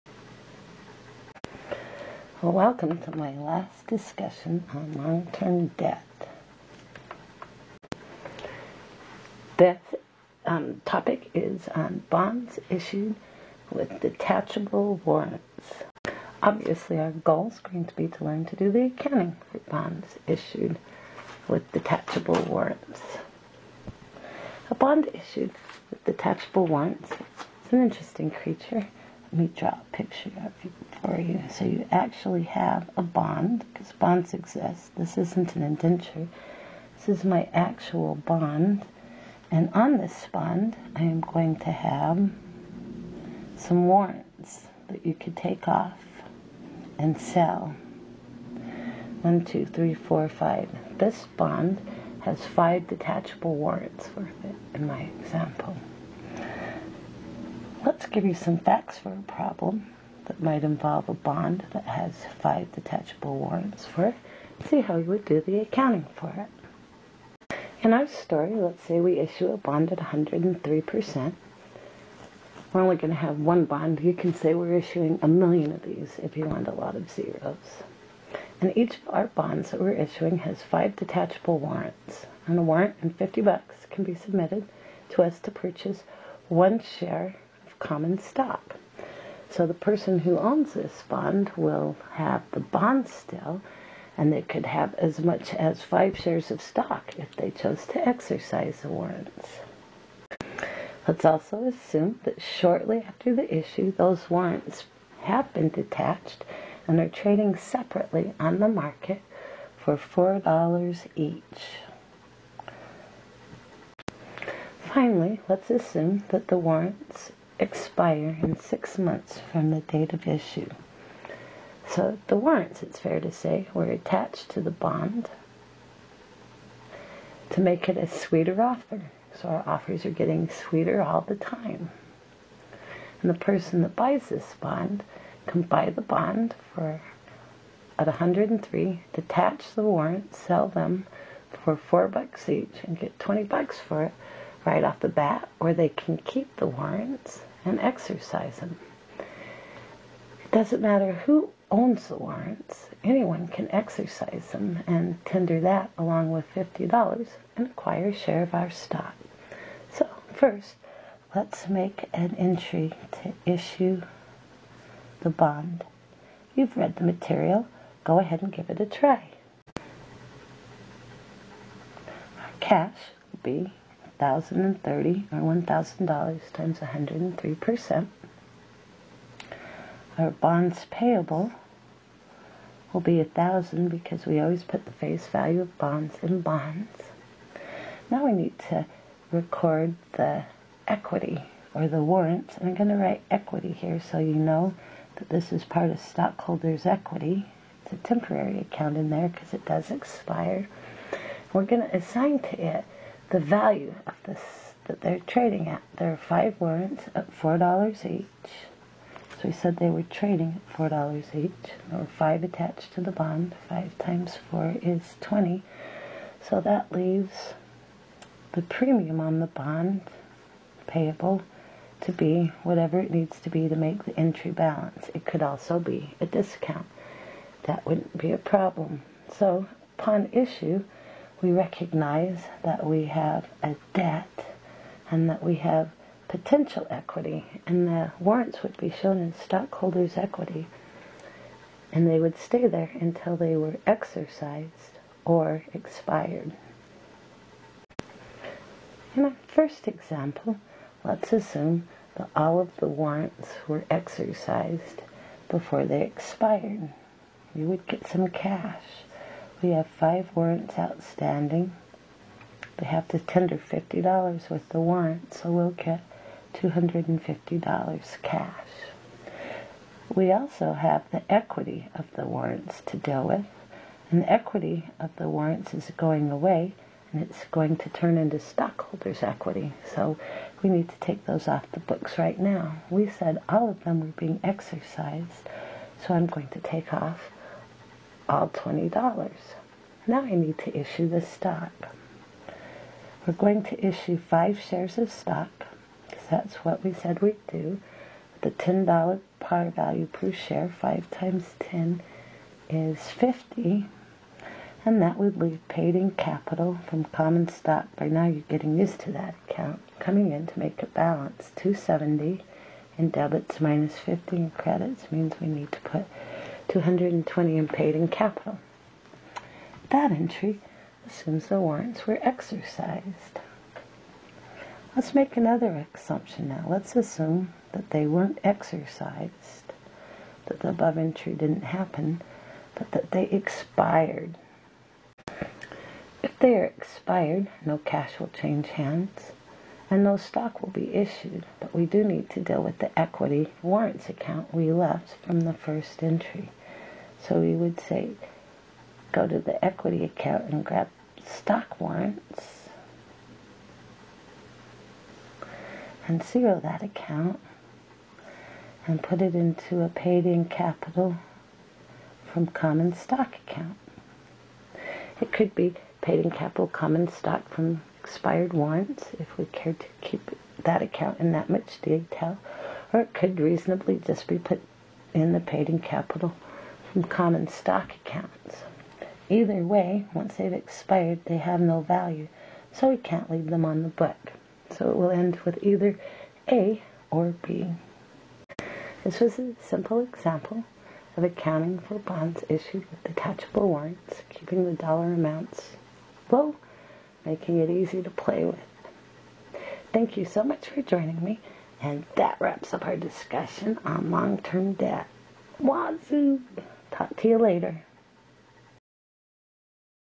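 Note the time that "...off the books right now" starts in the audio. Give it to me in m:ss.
4:41.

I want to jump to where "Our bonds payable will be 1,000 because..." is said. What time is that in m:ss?
3:00.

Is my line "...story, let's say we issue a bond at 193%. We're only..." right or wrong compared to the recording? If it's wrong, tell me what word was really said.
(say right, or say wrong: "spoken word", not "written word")
wrong: "103", not "193".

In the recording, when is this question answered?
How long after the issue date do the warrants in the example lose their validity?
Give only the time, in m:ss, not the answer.
1:58.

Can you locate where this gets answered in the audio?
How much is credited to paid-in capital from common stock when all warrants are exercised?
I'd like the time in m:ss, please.
5:16.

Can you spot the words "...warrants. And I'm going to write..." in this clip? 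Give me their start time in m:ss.
3:12.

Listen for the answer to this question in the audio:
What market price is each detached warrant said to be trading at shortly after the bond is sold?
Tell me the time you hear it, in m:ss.
1:49.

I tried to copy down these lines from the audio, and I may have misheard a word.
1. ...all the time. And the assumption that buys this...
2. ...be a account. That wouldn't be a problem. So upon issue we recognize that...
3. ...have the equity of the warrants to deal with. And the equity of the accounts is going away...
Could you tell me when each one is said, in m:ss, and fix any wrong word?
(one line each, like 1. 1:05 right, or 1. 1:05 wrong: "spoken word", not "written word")
1. 2:11 wrong: "person", not "assumption"
2. 3:45 wrong: "discount", not "account"
3. 4:30 wrong: "warrants", not "accounts".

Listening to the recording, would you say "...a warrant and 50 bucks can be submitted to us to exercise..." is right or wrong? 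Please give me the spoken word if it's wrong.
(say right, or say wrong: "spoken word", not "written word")
wrong: "purchase", not "exercise".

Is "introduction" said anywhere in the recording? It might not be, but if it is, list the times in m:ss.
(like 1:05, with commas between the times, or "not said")
not said.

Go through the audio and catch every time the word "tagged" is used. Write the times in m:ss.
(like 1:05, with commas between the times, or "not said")
not said.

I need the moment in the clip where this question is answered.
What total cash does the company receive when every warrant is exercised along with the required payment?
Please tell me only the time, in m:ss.
4:26.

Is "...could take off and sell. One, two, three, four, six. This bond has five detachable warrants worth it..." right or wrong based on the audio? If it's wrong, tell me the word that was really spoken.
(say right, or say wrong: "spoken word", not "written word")
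wrong: "five", not "six".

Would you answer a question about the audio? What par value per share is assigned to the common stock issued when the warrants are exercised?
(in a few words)
$10.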